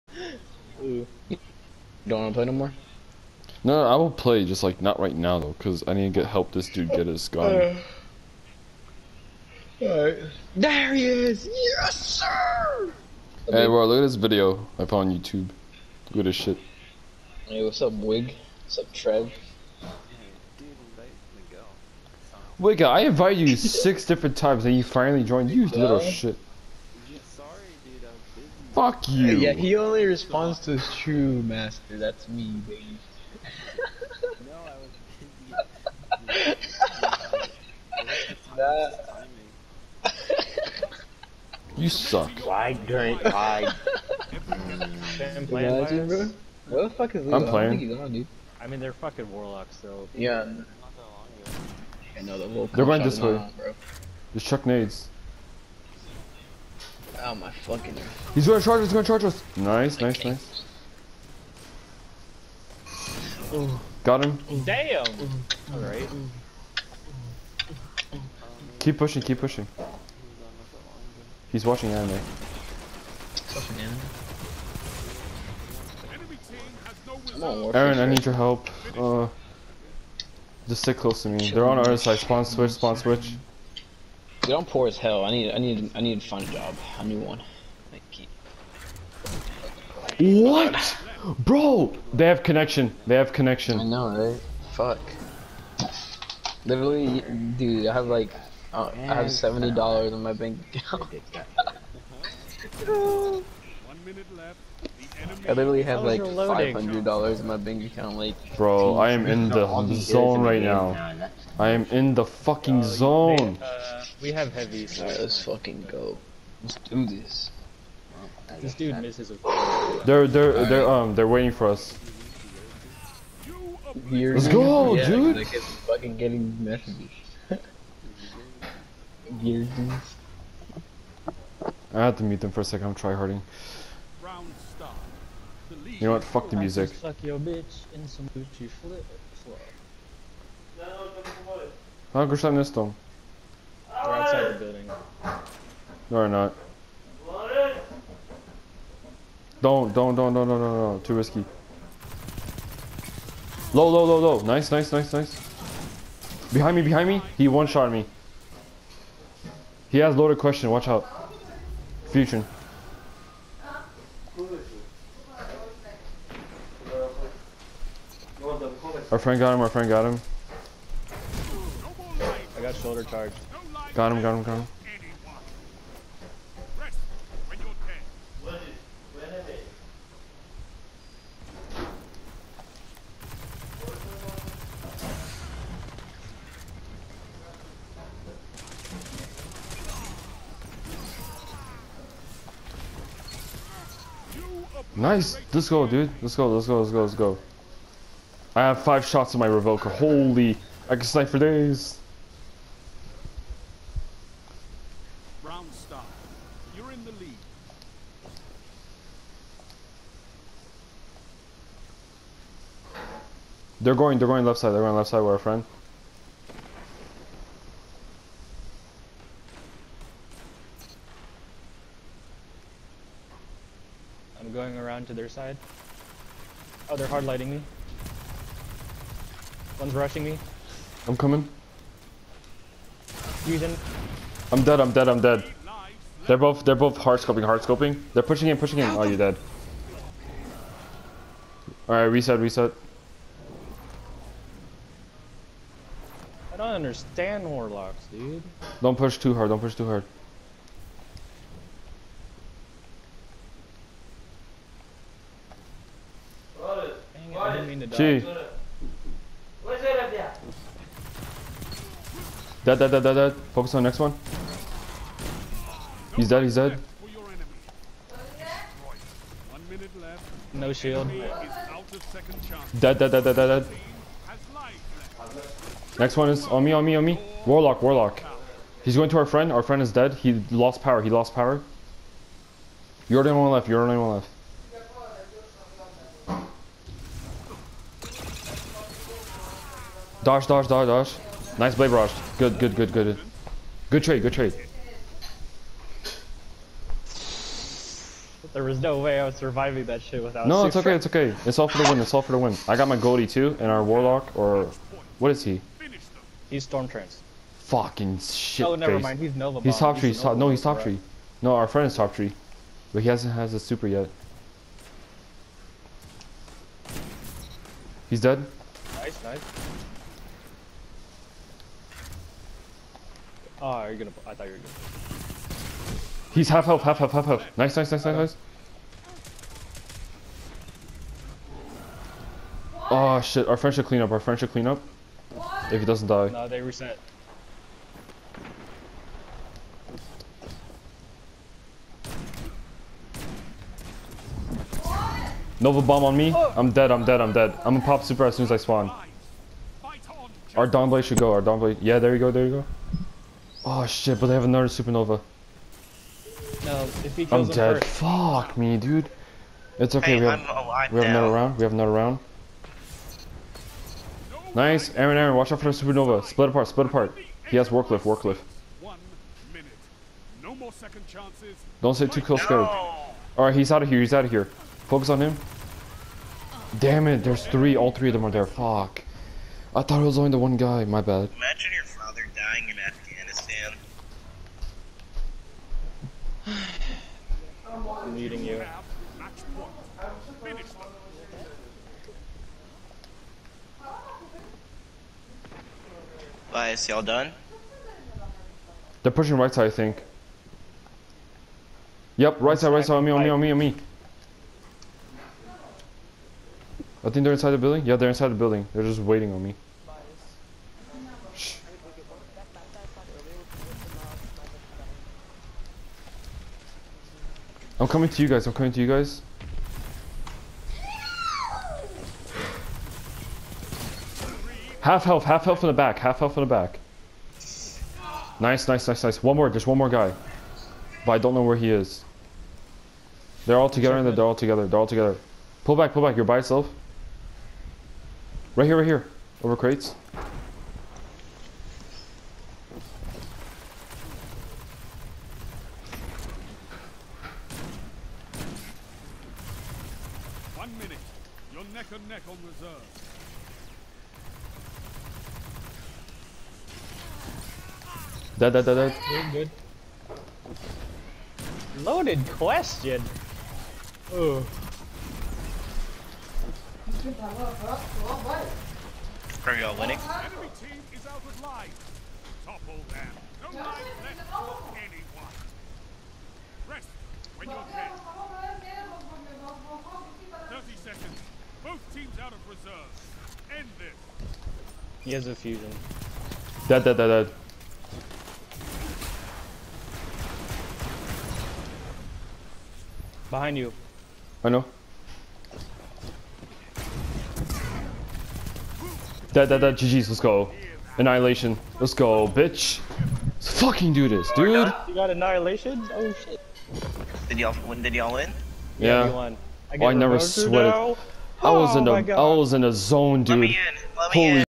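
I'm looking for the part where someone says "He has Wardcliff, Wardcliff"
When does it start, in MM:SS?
06:07.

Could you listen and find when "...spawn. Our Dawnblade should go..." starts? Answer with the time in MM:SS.
05:48.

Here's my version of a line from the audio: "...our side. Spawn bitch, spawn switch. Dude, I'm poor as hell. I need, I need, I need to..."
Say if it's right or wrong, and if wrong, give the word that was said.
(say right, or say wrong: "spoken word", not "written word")
wrong: "switch", not "bitch".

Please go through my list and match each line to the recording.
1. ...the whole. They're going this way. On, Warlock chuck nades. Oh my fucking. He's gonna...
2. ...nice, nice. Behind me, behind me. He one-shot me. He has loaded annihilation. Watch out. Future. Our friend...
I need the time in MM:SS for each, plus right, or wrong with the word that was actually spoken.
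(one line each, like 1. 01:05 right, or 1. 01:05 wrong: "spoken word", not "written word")
1. 00:52 wrong: "Just", not "Warlock"
2. 02:34 wrong: "question", not "annihilation".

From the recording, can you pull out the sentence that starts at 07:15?
Pull back, pull back, you're by yourself.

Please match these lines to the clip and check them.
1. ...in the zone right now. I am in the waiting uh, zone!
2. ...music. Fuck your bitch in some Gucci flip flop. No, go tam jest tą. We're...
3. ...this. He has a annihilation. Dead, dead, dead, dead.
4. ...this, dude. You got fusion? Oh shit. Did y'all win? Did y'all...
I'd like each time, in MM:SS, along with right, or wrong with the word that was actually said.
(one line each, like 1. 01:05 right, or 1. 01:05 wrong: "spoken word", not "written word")
1. 01:49 wrong: "fucking", not "waiting"
2. 02:16 right
3. 08:03 wrong: "fusion", not "annihilation"
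4. 08:24 wrong: "annihilation", not "fusion".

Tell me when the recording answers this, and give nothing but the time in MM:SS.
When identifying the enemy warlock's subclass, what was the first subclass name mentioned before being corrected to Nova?
05:06.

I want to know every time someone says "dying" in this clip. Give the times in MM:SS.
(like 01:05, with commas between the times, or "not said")
06:22.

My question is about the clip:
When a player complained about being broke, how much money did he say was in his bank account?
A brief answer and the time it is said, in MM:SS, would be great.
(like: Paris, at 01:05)
$70, at 01:39.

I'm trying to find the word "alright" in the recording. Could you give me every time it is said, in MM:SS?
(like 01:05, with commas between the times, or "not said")
00:09, 01:05, 04:01, 06:13.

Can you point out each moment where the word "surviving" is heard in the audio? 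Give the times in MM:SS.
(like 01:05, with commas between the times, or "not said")
04:59.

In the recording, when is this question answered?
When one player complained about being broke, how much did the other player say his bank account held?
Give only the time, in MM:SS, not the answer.
01:46.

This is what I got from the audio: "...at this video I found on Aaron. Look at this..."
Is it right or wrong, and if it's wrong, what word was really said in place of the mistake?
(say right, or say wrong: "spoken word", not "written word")
wrong: "YouTube", not "Aaron".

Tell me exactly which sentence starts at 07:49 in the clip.
Enemy team is out of Topple them.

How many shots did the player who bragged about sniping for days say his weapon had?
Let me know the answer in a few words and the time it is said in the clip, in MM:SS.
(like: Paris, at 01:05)
5, at 03:18.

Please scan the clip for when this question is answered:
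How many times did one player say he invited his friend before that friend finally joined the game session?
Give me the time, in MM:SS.
00:23.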